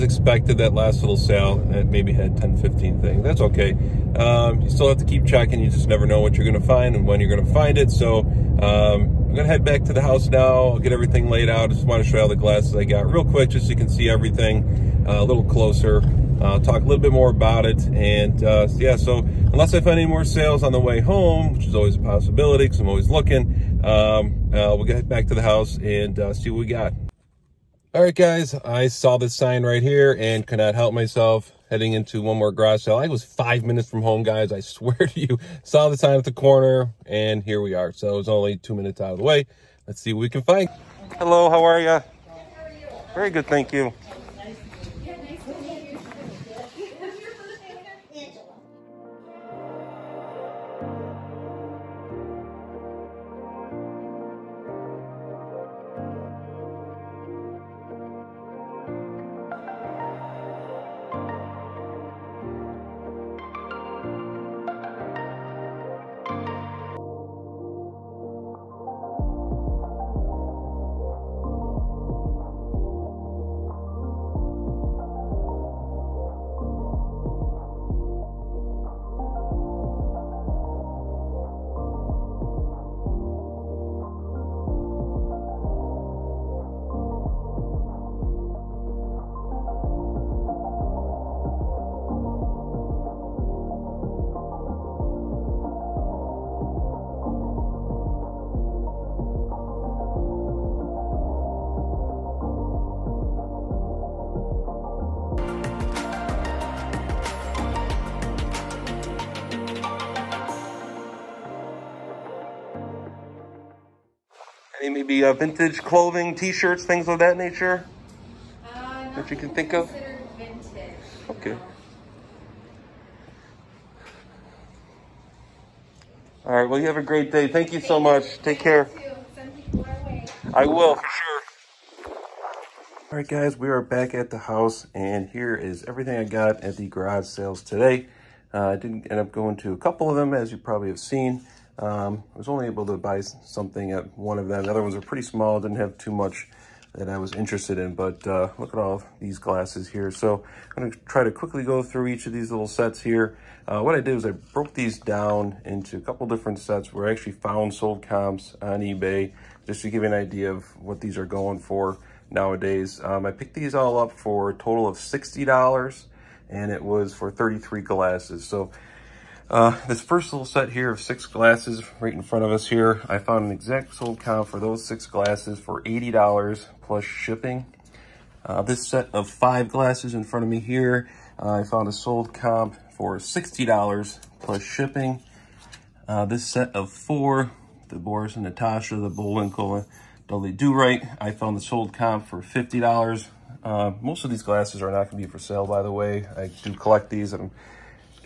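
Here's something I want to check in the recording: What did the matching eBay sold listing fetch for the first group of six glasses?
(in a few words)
$80.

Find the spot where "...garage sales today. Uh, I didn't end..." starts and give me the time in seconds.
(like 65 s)
136 s.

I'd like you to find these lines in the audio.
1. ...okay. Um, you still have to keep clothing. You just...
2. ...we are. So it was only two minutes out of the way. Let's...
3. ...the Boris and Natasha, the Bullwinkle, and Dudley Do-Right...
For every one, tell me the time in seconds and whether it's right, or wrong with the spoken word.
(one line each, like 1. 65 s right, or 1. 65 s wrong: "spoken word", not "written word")
1. 3 s wrong: "checking", not "clothing"
2. 37 s right
3. 187 s right.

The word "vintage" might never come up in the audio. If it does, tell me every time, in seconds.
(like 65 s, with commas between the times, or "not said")
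115 s, 119 s.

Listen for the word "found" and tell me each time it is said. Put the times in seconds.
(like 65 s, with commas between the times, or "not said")
157 s, 173 s, 181 s, 191 s.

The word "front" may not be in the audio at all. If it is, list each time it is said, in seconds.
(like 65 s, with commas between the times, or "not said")
172 s, 180 s.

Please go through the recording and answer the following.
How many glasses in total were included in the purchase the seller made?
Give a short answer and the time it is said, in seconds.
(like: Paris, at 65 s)
33, at 167 s.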